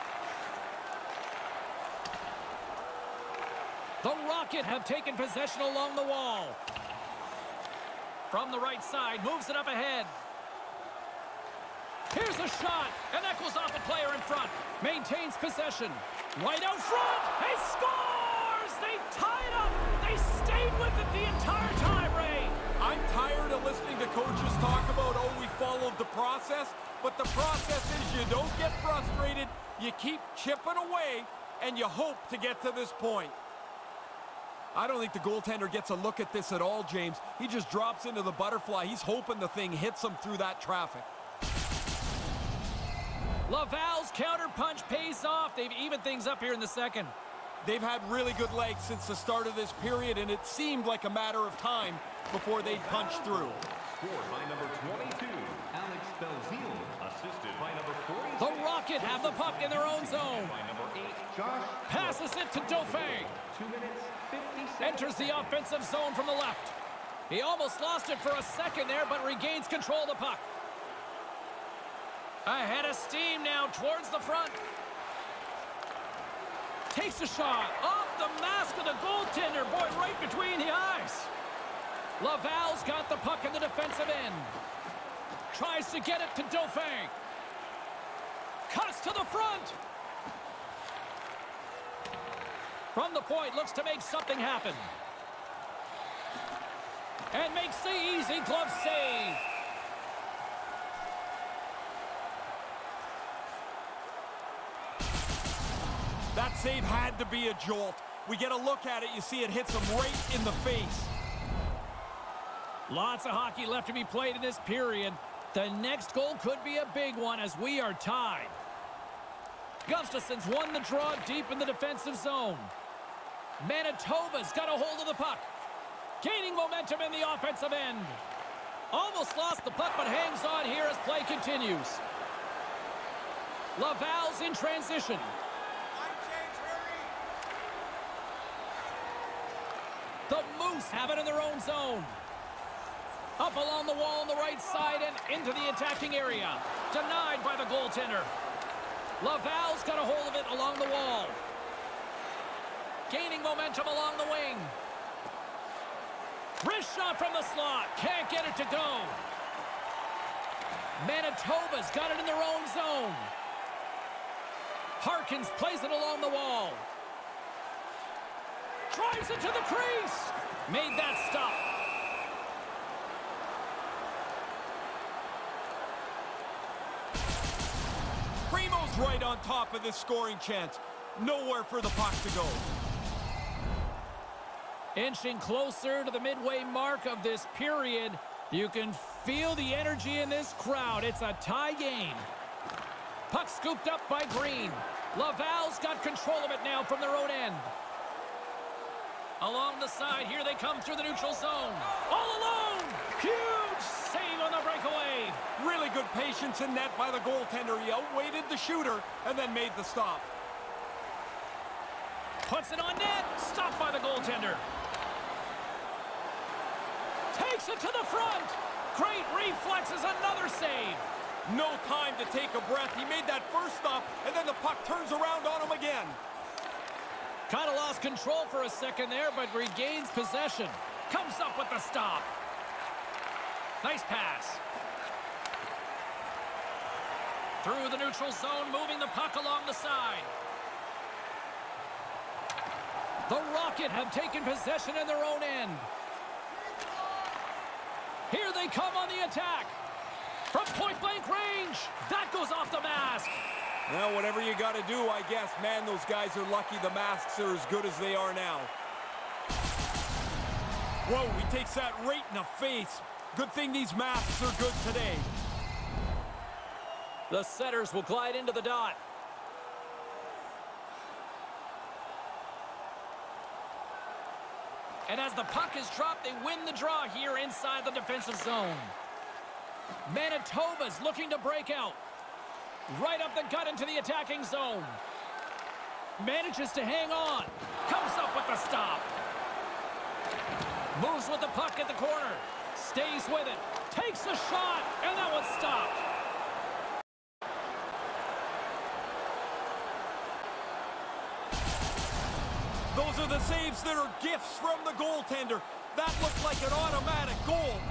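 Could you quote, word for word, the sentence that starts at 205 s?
Really good patience in net by the goaltender.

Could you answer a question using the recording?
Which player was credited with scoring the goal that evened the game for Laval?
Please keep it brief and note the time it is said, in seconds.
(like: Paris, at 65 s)
Alex Belzile, at 55 s.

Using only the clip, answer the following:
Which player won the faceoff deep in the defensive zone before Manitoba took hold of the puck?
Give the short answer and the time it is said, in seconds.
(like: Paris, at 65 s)
Gustafsson, at 119 s.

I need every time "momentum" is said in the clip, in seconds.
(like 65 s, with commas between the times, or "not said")
126 s, 153 s.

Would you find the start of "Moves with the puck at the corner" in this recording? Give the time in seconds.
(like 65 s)
291 s.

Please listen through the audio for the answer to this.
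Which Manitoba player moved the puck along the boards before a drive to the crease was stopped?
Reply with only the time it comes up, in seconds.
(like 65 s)
165 s.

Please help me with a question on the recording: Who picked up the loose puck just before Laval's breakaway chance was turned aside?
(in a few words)
Green.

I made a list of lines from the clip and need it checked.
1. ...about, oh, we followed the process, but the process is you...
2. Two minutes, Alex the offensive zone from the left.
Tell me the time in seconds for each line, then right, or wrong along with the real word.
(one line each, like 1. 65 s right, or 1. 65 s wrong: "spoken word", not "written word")
1. 24 s right
2. 63 s wrong: "Enters", not "Alex".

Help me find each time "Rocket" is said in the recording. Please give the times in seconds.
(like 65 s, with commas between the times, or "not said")
4 s, 58 s, 243 s.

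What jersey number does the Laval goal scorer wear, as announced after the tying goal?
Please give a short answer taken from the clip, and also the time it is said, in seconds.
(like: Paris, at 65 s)
22, at 54 s.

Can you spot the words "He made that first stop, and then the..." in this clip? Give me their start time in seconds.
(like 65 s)
222 s.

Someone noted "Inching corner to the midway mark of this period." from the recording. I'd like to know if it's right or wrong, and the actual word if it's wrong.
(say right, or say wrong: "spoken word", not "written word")
wrong: "closer", not "corner".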